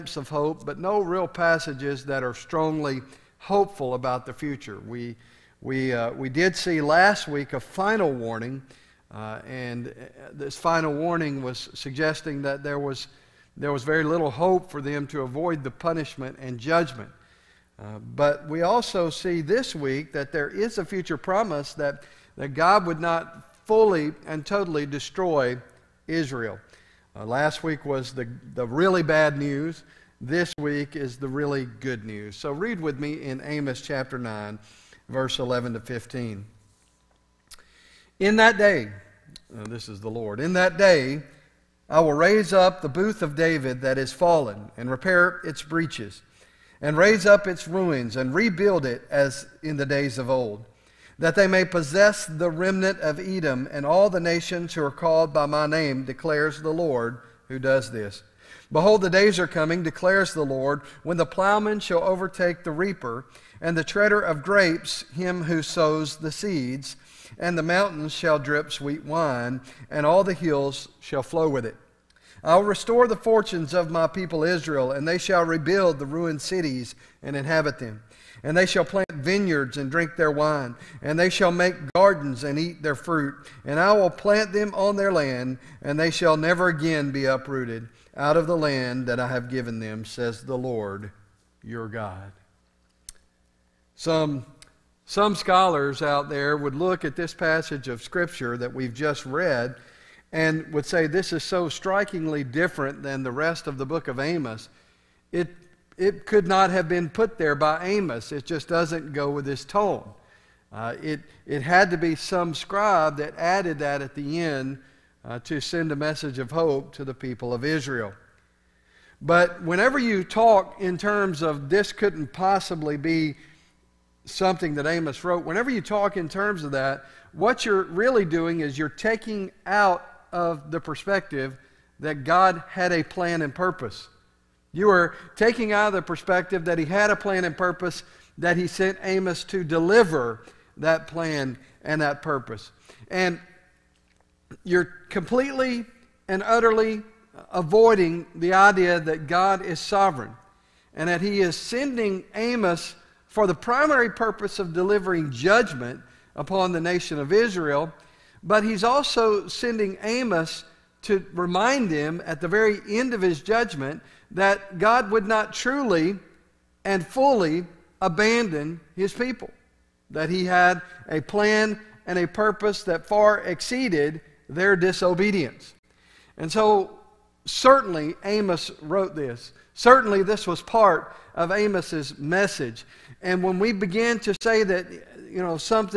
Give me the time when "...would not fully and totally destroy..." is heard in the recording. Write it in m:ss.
0:22.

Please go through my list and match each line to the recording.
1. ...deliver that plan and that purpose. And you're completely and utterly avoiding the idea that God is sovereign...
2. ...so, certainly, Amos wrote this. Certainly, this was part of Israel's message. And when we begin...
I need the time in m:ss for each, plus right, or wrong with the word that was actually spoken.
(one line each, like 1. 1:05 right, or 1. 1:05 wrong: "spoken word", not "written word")
1. 2:19 right
2. 2:56 wrong: "Amos", not "Israel".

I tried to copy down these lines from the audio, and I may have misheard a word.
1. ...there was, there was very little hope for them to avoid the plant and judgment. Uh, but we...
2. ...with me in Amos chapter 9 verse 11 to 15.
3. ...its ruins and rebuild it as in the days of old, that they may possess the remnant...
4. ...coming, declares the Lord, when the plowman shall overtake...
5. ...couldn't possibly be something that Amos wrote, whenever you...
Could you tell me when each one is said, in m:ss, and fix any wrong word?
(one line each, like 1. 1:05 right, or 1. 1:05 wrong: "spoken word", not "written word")
1. 0:12 wrong: "punishment", not "plant"
2. 0:32 right
3. 0:47 right
4. 0:59 right
5. 2:01 right.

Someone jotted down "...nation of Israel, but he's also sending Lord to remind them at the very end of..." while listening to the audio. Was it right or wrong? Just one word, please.
wrong.